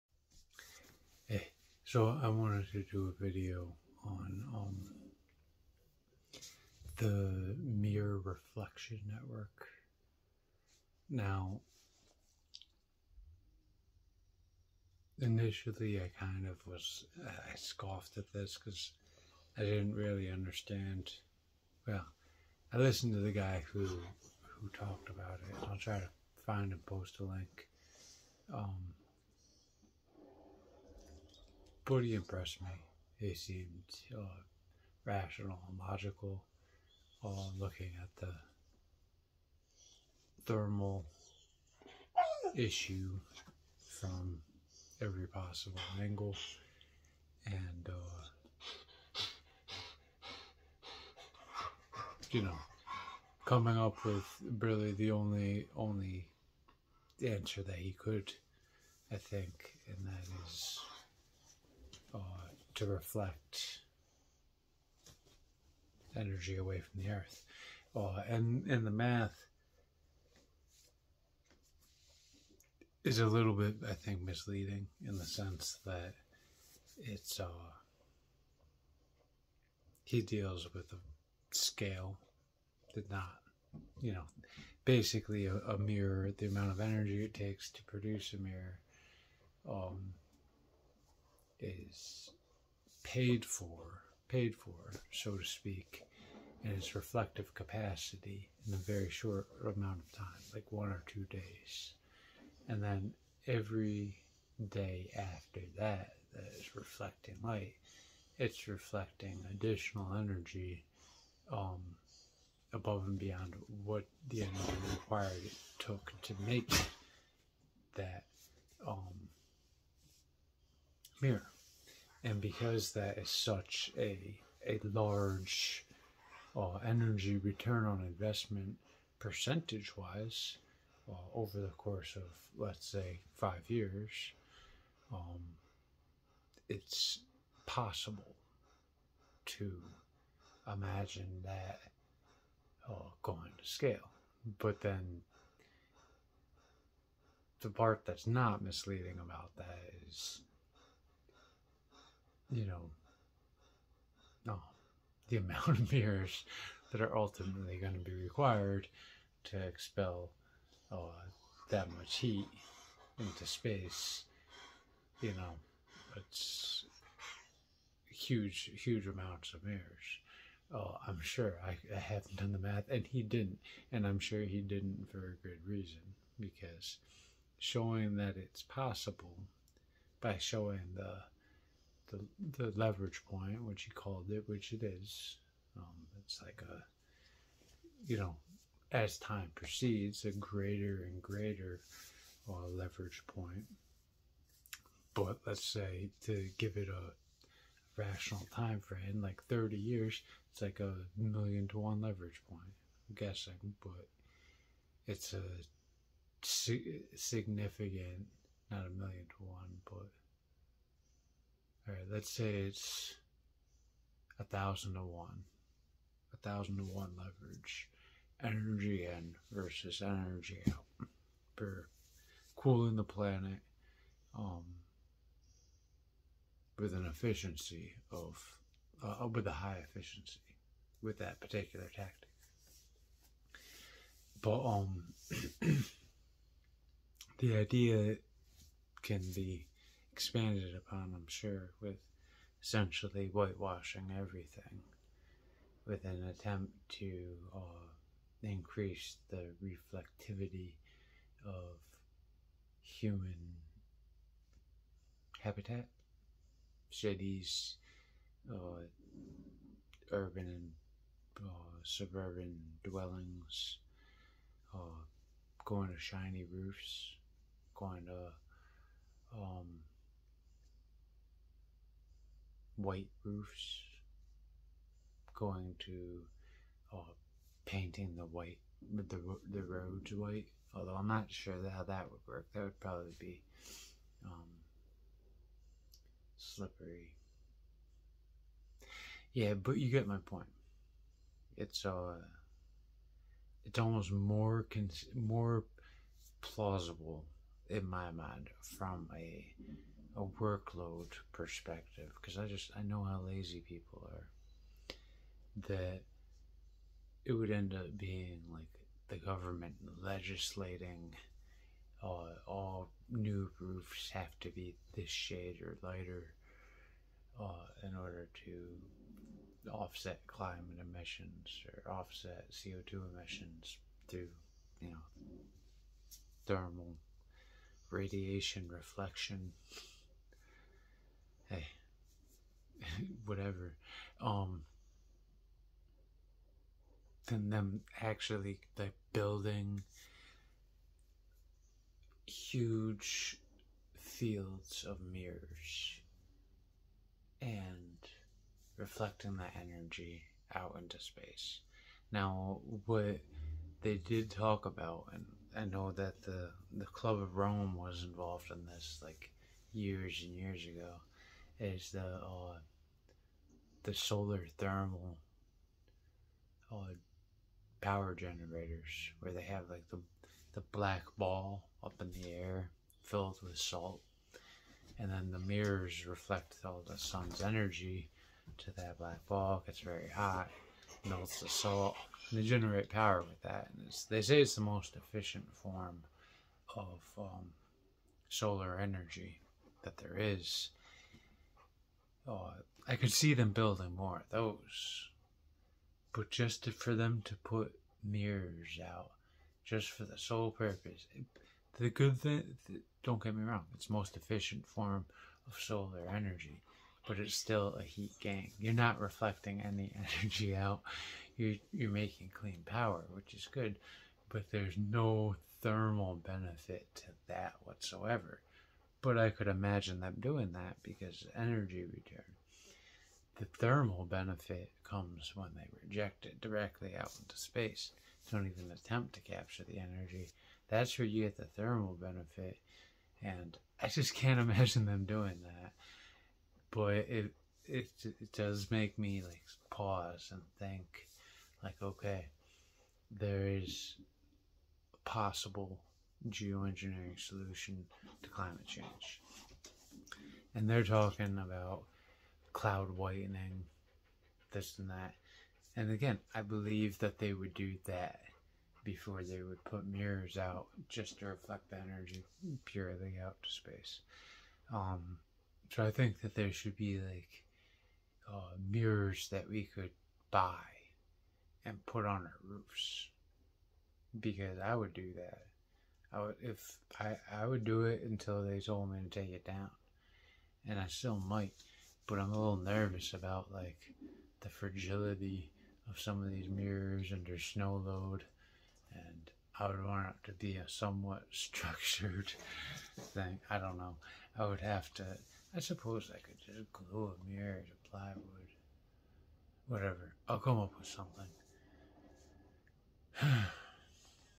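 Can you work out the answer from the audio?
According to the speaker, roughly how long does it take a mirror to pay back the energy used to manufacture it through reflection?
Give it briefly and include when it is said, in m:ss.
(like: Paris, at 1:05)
one or two days, at 1:40.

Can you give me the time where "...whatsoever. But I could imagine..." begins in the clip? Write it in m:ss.
6:57.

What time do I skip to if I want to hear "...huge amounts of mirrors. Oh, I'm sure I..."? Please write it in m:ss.
2:48.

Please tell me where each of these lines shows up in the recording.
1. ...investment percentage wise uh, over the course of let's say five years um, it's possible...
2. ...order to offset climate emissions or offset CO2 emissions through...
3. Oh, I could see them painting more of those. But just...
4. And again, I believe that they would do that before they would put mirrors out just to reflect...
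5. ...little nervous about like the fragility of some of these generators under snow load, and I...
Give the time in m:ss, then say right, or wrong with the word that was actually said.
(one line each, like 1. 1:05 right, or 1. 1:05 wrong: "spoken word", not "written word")
1. 2:08 right
2. 5:17 right
3. 6:32 wrong: "building", not "painting"
4. 7:35 right
5. 8:02 wrong: "mirrors", not "generators".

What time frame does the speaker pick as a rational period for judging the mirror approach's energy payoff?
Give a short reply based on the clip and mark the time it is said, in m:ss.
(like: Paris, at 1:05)
30 years, at 3:19.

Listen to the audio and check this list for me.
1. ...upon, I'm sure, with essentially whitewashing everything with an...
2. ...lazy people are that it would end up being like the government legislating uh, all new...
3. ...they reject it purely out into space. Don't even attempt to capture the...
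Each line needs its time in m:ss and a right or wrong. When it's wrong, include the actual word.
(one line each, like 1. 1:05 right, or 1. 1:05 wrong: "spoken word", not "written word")
1. 4:00 right
2. 5:03 right
3. 7:05 wrong: "directly", not "purely".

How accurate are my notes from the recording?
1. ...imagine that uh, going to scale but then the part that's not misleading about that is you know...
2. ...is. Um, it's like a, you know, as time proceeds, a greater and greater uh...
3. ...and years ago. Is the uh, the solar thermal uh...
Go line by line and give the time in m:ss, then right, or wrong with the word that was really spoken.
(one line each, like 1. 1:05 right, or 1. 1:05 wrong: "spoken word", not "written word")
1. 2:20 right
2. 3:04 right
3. 6:00 right.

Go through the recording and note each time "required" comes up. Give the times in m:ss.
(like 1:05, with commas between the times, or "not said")
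1:54, 2:38.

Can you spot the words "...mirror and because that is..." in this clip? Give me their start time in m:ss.
2:01.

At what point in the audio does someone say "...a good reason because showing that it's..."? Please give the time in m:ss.
2:55.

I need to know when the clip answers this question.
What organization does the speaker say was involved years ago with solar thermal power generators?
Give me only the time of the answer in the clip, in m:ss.
5:56.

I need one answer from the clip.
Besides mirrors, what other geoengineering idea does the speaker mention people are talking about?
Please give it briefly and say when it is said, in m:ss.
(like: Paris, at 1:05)
cloud whitening, at 7:32.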